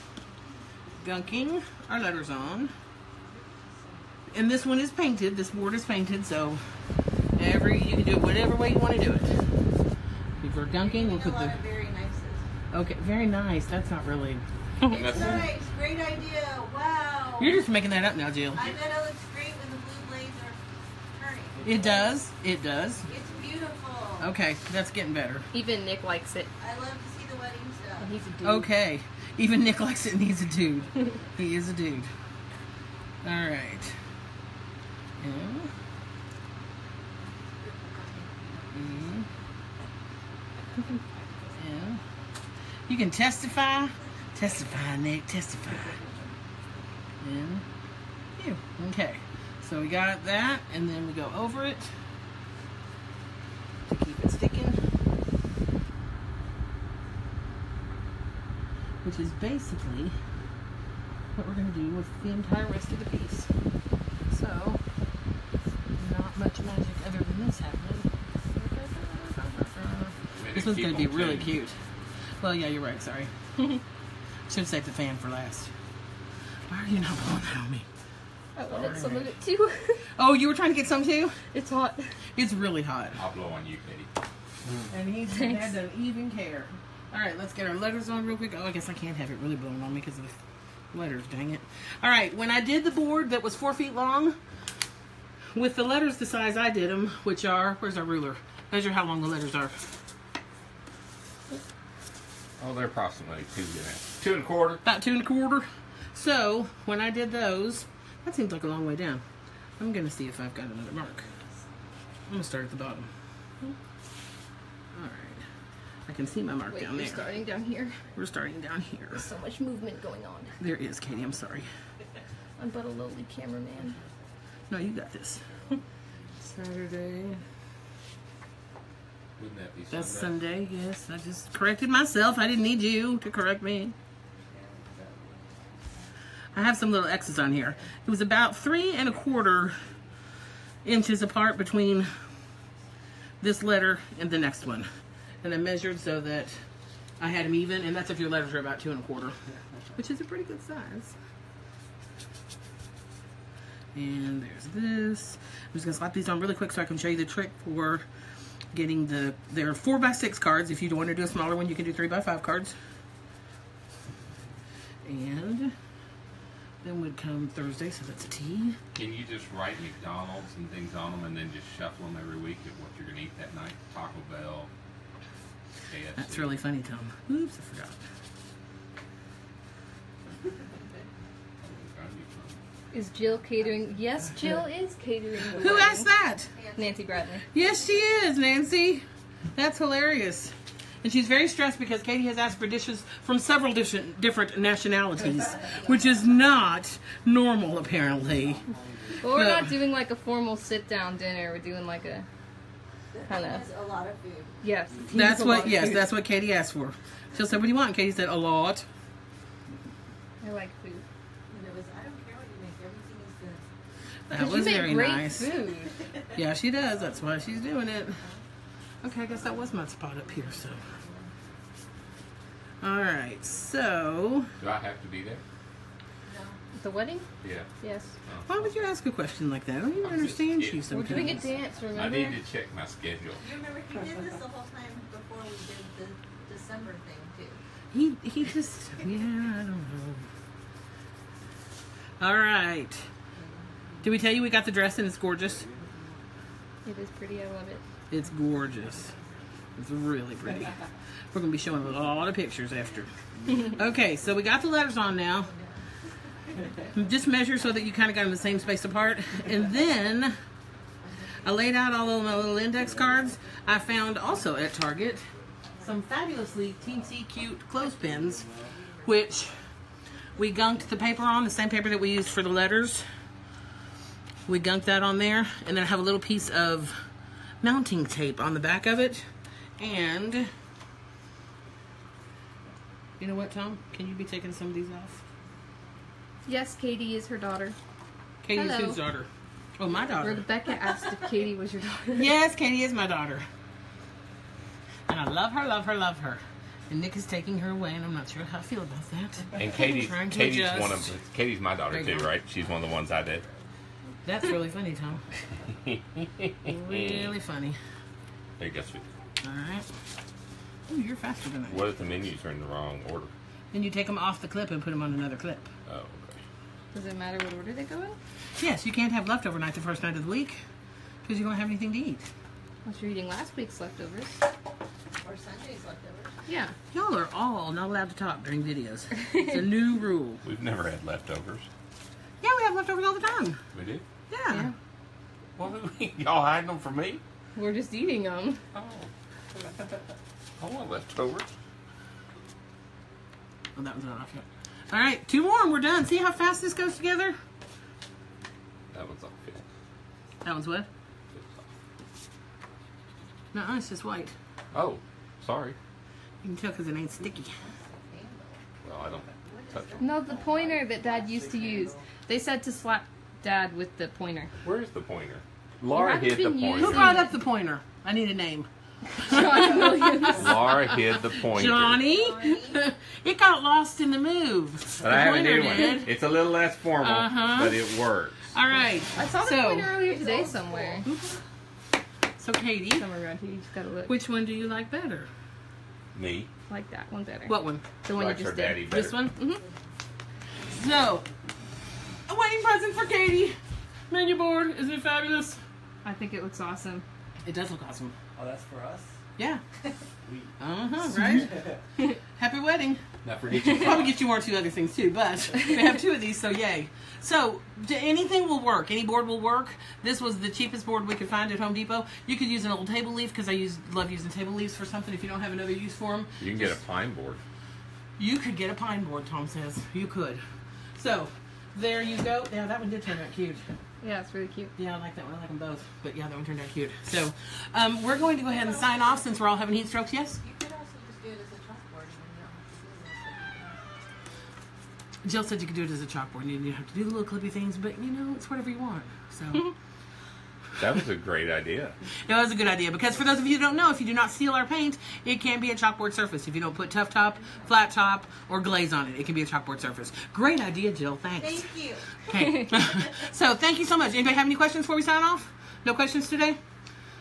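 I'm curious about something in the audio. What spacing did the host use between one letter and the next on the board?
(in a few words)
3 1/4 inches.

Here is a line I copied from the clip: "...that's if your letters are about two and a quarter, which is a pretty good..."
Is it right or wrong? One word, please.
right.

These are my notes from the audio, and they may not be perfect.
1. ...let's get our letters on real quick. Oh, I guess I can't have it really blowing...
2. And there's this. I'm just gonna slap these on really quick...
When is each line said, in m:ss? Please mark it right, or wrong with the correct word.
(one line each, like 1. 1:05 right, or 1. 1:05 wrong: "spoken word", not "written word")
1. 1:27 right
2. 2:33 right.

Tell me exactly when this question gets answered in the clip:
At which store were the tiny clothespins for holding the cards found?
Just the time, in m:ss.
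4:24.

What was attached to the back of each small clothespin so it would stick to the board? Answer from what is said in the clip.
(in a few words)
mounting tape.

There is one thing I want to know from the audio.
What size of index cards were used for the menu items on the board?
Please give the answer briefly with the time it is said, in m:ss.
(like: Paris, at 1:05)
4 by 6, at 2:39.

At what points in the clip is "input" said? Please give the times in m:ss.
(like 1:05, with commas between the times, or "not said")
not said.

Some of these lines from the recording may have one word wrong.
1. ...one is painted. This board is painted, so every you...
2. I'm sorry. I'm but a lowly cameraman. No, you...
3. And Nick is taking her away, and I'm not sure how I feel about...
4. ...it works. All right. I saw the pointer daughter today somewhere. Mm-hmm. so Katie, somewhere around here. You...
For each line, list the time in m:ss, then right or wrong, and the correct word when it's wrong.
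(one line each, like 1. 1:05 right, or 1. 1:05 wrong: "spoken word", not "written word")
1. 0:04 right
2. 2:01 right
3. 4:56 right
4. 6:17 wrong: "earlier", not "daughter".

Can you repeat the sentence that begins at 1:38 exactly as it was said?
Measure how long the letters are.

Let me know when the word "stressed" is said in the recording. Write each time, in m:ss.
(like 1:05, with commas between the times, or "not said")
3:11.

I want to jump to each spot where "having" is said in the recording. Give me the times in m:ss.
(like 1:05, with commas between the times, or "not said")
7:09.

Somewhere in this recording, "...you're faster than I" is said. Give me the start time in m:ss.
5:11.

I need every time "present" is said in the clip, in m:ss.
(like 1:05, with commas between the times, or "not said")
6:32.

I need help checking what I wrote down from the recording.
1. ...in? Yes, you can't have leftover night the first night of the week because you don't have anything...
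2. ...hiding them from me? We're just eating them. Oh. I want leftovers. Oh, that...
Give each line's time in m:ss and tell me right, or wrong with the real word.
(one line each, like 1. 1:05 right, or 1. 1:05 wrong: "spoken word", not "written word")
1. 5:18 right
2. 5:36 right.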